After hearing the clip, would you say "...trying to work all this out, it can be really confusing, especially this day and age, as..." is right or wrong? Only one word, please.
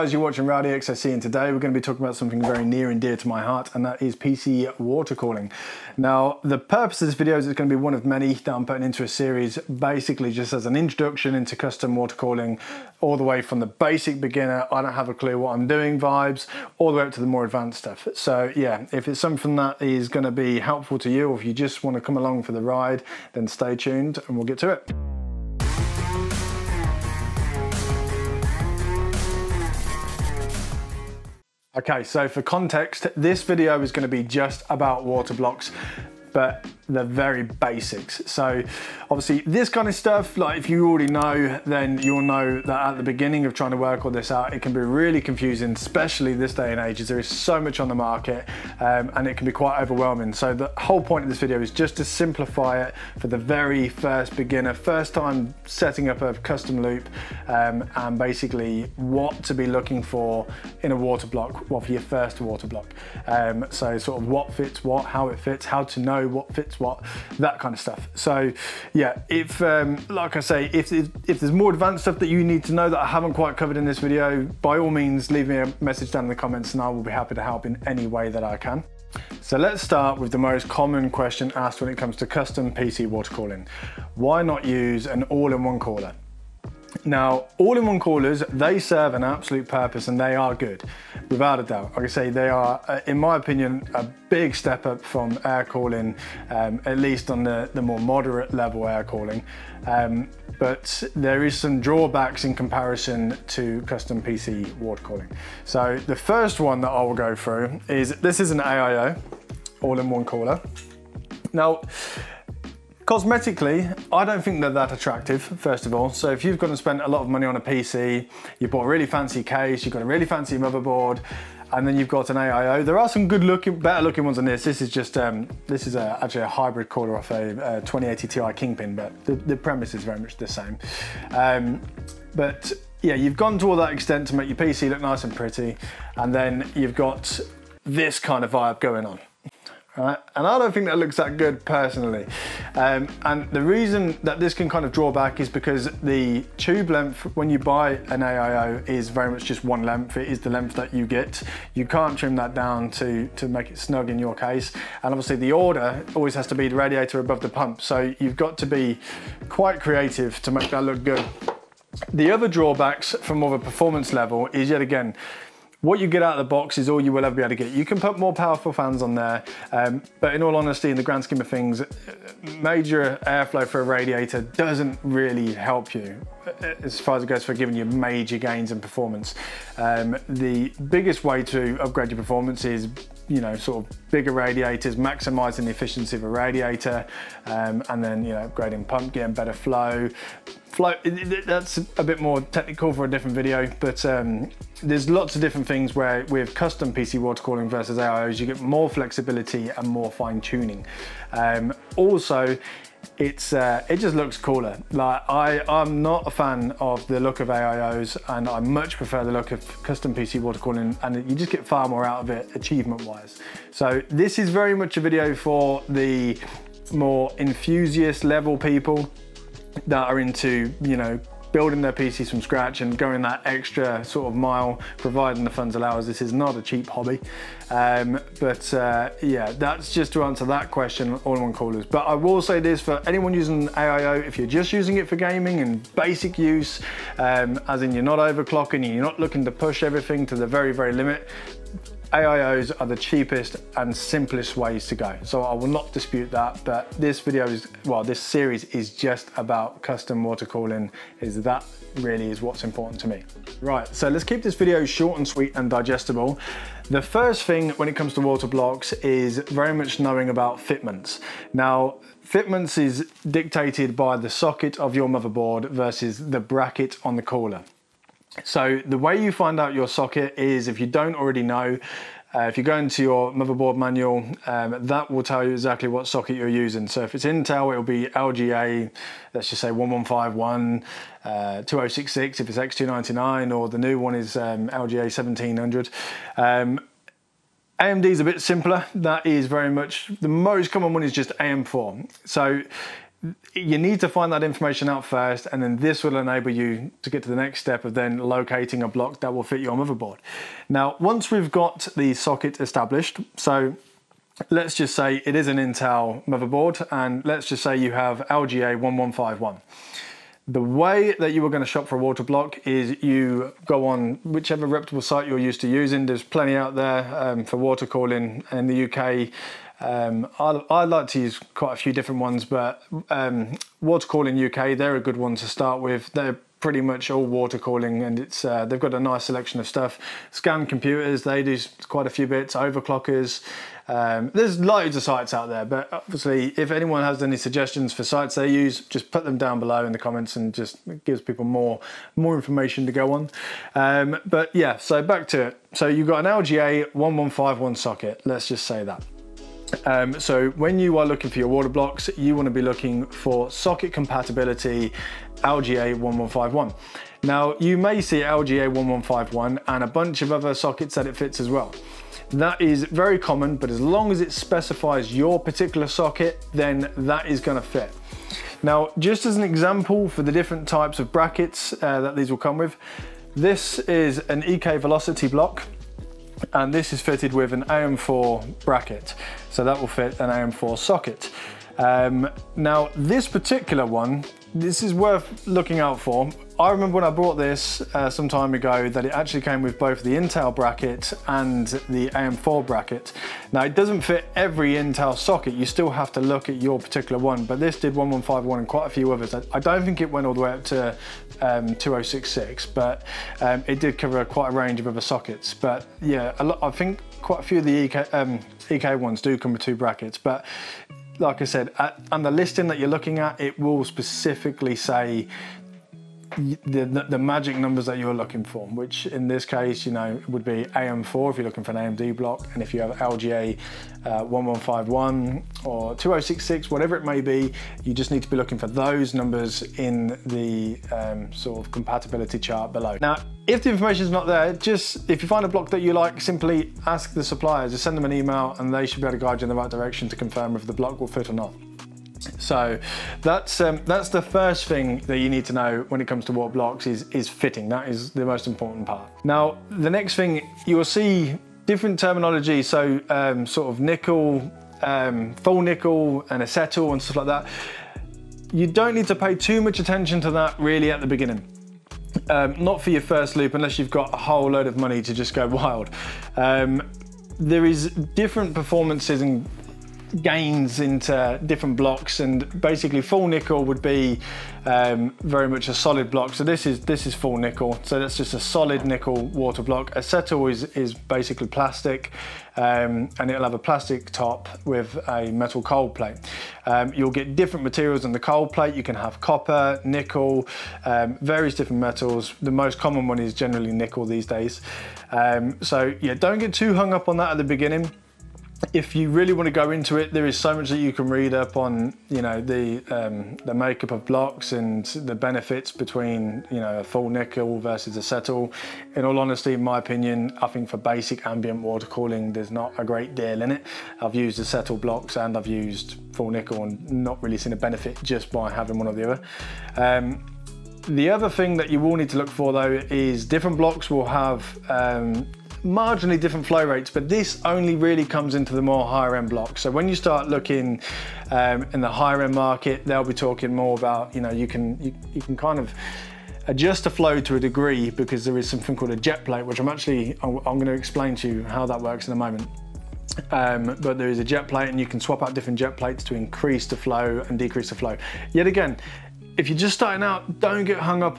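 right.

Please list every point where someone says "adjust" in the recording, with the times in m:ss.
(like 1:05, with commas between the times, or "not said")
8:56.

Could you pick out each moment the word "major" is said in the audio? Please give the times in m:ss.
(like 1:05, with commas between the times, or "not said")
2:52, 2:57.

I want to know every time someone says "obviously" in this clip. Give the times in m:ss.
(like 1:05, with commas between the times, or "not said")
0:39, 2:35, 5:35.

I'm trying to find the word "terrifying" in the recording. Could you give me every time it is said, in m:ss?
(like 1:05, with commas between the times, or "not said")
not said.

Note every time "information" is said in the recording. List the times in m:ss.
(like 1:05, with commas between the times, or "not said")
4:54, 5:42, 7:13.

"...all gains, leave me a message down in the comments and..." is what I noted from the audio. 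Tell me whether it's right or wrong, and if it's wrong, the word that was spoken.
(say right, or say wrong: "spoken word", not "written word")
wrong: "means", not "gains".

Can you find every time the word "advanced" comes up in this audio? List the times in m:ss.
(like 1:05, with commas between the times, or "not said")
0:17, 1:11.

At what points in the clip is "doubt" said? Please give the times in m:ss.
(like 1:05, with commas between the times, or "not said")
1:31.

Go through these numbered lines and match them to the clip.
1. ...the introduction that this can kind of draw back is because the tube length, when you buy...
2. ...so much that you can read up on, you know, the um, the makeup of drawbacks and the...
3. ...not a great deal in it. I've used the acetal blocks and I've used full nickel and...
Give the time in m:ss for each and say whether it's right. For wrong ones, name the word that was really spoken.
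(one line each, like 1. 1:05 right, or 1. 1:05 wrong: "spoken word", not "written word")
1. 2:23 wrong: "reason", not "introduction"
2. 8:20 wrong: "blocks", not "drawbacks"
3. 8:32 right.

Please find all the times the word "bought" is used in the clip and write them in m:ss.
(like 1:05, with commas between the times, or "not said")
1:58, 6:27.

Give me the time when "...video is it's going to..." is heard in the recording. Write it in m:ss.
0:07.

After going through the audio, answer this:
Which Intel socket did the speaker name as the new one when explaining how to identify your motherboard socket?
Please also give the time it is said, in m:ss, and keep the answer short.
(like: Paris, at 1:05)
LGA 1700, at 4:44.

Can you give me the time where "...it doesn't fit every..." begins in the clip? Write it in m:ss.
6:33.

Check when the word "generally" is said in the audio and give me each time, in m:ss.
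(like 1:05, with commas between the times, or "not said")
8:13.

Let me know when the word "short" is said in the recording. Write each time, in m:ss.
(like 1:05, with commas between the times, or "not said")
4:14.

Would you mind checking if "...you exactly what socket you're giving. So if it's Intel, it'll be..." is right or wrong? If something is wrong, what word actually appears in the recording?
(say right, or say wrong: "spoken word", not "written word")
wrong: "using", not "giving".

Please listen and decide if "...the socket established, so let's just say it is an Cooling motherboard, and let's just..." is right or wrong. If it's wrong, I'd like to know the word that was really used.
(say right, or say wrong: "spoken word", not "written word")
wrong: "Intel", not "Cooling".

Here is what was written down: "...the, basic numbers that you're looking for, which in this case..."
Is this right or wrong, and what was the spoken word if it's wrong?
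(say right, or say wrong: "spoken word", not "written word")
wrong: "magic", not "basic".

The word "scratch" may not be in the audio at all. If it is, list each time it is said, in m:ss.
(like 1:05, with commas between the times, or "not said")
3:42.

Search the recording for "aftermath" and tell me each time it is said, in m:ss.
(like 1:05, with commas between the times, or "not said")
not said.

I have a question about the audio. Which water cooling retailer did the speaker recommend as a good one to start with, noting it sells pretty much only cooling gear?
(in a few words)
Water Cooling UK.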